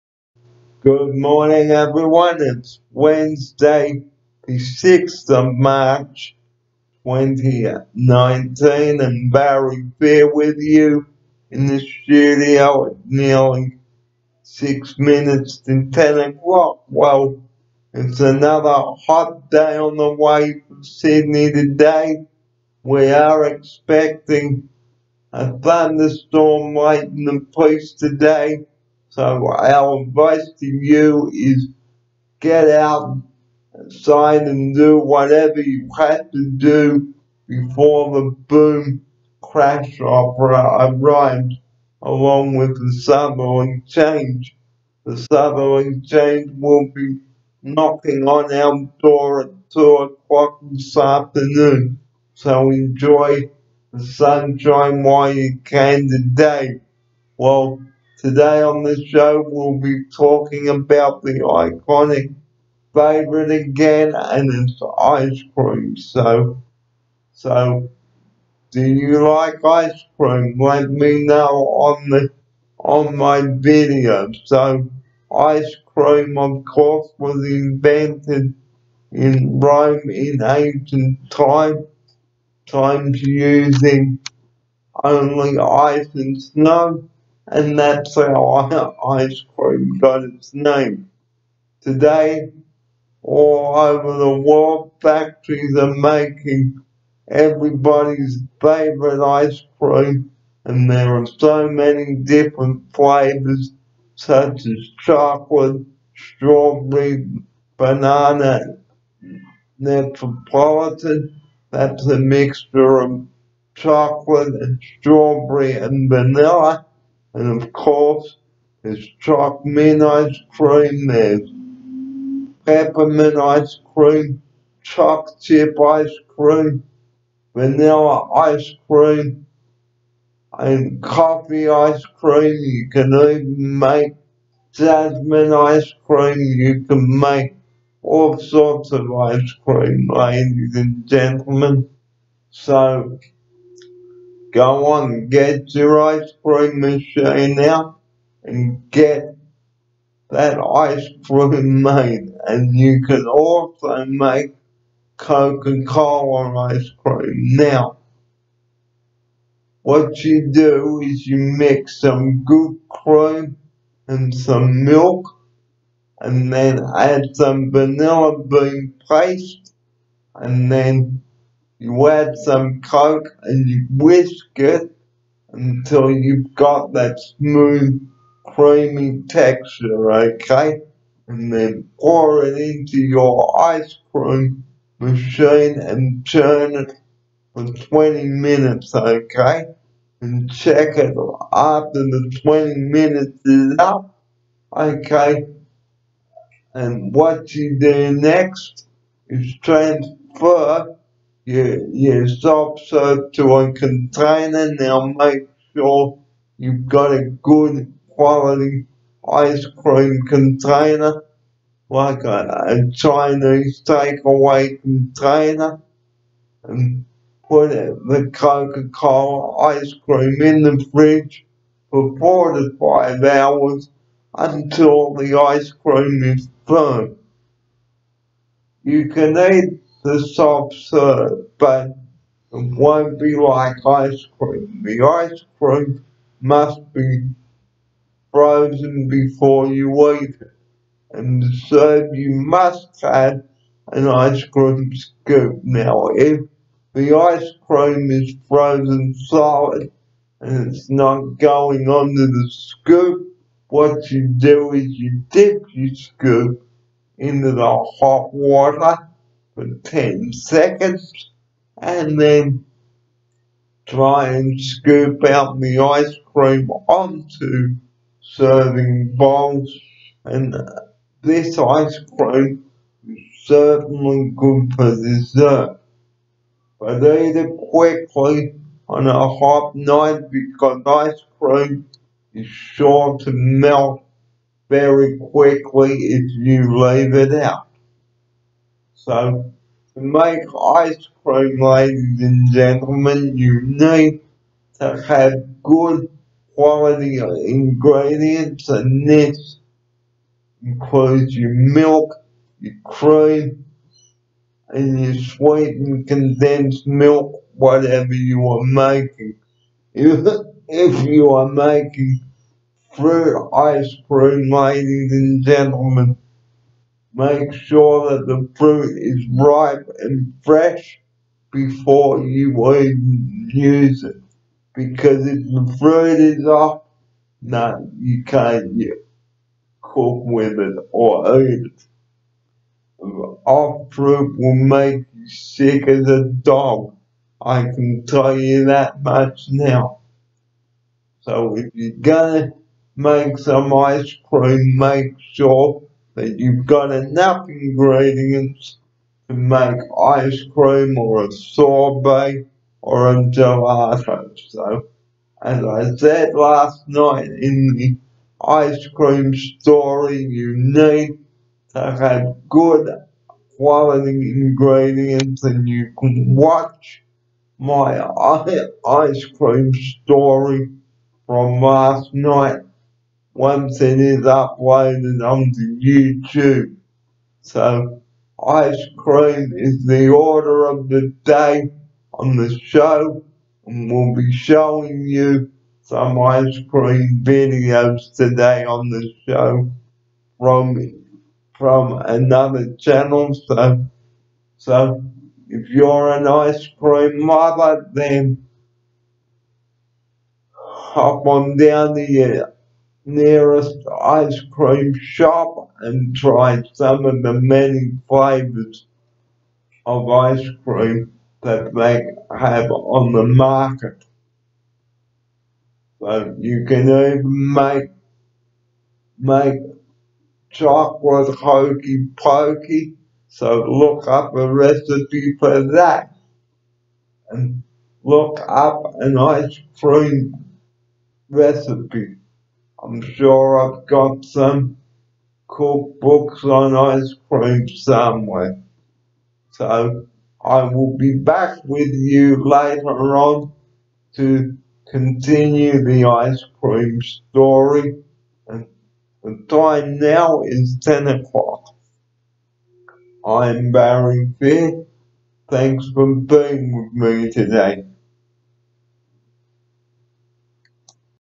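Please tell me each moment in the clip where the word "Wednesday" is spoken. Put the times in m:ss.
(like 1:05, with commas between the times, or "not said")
0:02.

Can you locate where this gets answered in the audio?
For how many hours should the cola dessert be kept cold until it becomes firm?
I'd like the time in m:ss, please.
3:42.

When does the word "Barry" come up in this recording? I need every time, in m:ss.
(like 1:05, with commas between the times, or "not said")
0:09, 7:33.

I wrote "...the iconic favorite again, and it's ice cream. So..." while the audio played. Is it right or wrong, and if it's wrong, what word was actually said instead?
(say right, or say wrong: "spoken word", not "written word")
right.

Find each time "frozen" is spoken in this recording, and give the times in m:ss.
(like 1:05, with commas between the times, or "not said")
3:58, 4:08.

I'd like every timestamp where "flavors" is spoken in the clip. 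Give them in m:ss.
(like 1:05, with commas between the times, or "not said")
1:42, 6:48.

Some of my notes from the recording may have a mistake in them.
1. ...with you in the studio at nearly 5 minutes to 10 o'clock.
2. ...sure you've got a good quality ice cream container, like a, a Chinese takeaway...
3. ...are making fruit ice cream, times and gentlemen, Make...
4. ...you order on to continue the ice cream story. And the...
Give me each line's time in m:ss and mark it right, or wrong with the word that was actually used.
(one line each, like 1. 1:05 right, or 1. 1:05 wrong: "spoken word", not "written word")
1. 0:10 wrong: "6", not "5"
2. 3:25 right
3. 5:11 wrong: "ladies", not "times"
4. 7:21 wrong: "later", not "order".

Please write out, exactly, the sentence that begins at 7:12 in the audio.
I'm sure I've got some cookbooks on ice cream somewhere.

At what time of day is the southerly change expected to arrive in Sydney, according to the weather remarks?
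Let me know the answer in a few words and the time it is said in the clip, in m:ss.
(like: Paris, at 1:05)
2 o'clock, at 0:49.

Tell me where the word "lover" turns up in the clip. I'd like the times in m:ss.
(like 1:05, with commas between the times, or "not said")
6:37.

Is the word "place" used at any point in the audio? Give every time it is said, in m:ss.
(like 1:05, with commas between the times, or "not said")
0:27.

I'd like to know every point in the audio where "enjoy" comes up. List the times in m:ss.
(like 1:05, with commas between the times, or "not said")
0:52.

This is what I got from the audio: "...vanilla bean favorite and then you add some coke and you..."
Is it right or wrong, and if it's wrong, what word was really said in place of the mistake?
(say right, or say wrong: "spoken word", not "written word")
wrong: "paste", not "favorite".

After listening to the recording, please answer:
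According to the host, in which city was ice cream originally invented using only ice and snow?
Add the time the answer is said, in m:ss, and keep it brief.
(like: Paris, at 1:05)
Rome, at 1:19.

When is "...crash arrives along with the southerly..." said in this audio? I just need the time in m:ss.
0:39.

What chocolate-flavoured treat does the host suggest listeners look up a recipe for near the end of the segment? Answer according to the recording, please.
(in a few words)
chocolate hokey pokey.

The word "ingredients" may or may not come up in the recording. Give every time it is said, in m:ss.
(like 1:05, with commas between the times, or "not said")
4:57, 5:47, 6:04.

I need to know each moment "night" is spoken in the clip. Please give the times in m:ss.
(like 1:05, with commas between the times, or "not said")
4:39, 5:56, 6:12.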